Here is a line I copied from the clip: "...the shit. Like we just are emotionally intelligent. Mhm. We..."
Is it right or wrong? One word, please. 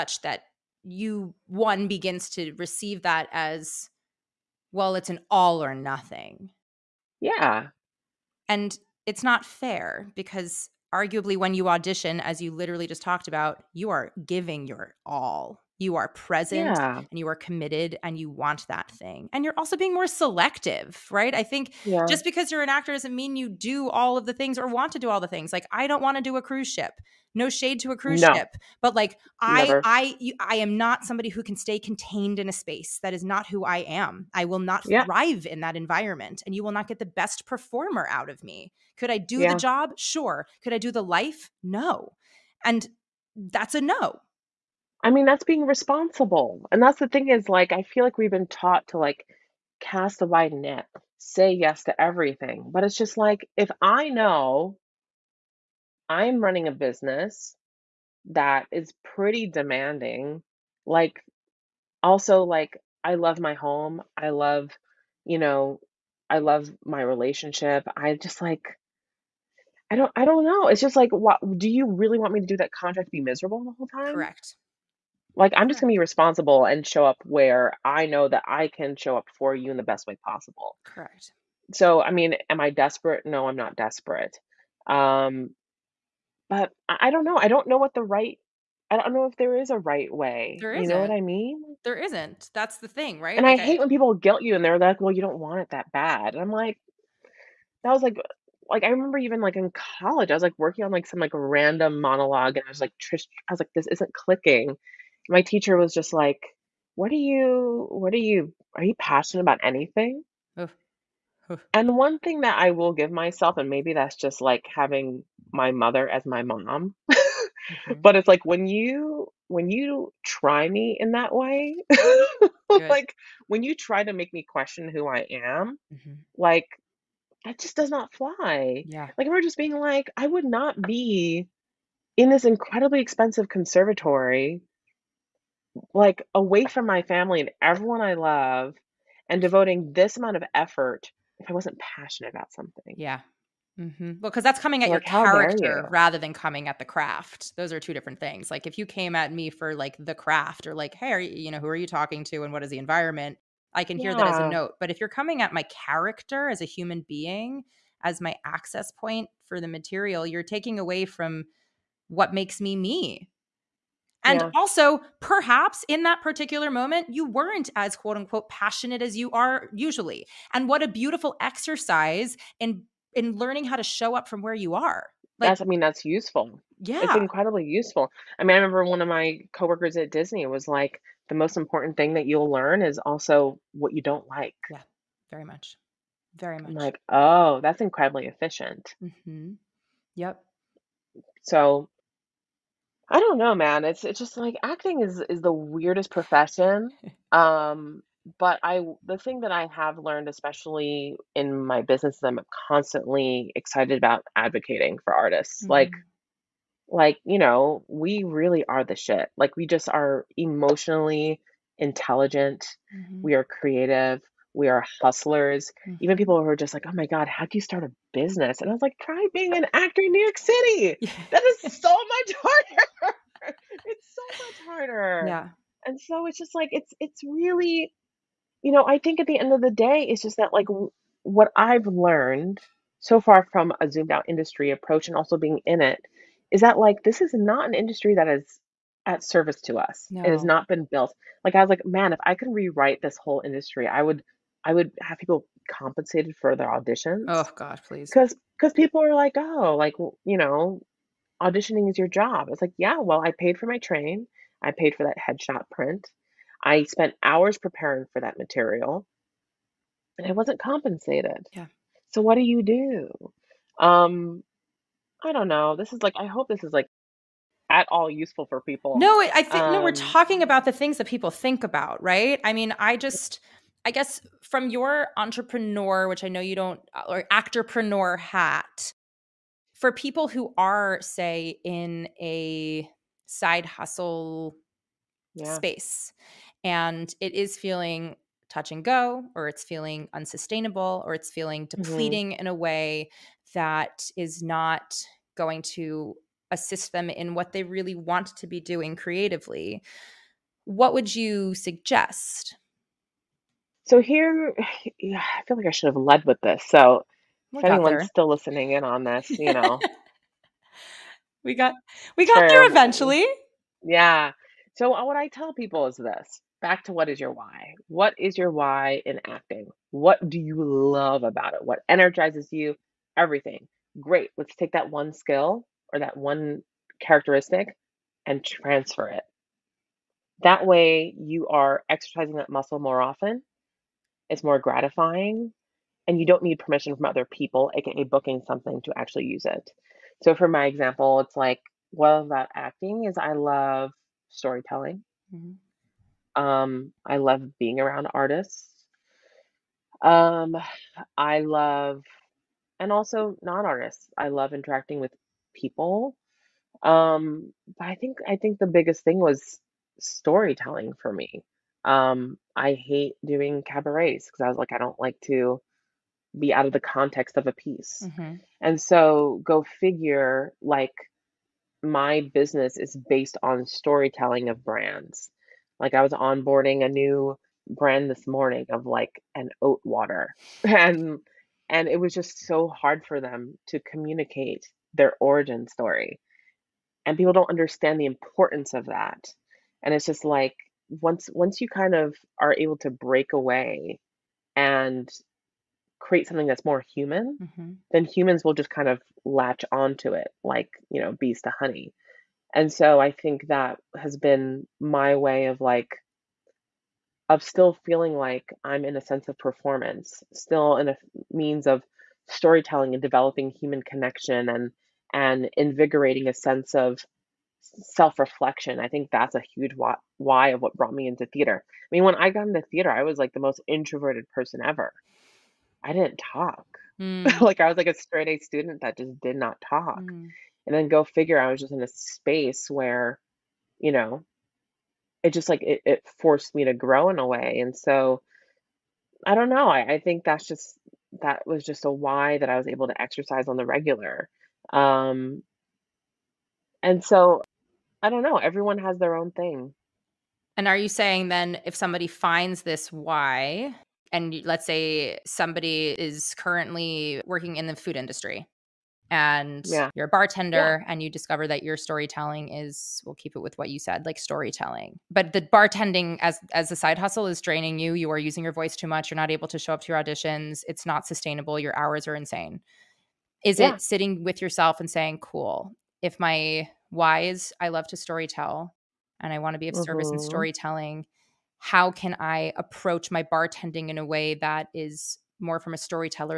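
right.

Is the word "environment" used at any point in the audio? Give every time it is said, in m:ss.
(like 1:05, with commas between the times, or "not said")
0:35, 2:32.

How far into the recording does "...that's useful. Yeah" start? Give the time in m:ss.
2:55.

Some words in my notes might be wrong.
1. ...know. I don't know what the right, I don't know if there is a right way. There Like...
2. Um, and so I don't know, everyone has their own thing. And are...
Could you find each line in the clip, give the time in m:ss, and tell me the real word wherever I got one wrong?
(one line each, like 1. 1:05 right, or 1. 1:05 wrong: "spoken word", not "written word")
1. 1:27 wrong: "You", not "Like"
2. 7:24 right.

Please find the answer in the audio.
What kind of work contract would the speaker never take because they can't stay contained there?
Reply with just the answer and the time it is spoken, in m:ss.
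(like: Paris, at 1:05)
Cruise ship, at 0:26.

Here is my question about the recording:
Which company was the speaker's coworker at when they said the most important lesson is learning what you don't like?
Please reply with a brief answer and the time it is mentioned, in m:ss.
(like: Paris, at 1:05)
Disney, at 3:00.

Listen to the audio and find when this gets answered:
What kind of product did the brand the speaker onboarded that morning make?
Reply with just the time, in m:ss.
6:19.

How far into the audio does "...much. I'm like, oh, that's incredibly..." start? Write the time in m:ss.
3:06.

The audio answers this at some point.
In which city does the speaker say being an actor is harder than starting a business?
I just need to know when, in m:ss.
3:40.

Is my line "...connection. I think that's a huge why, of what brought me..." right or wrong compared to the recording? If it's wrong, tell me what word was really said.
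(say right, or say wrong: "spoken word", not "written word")
wrong: "reflection", not "connection".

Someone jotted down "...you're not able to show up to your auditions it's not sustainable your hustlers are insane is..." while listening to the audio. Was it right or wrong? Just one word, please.
wrong.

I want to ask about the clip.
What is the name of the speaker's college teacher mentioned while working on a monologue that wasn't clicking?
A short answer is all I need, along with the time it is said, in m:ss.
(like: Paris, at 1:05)
Trish, at 1:43.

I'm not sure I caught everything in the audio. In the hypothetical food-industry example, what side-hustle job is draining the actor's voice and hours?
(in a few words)
Bartender.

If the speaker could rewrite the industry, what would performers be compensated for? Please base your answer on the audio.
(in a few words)
Their auditions.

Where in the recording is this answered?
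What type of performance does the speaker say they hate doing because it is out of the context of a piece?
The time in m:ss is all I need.
6:03.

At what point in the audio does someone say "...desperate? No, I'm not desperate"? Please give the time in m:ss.
1:22.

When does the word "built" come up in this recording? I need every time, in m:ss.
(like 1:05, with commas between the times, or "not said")
4:00.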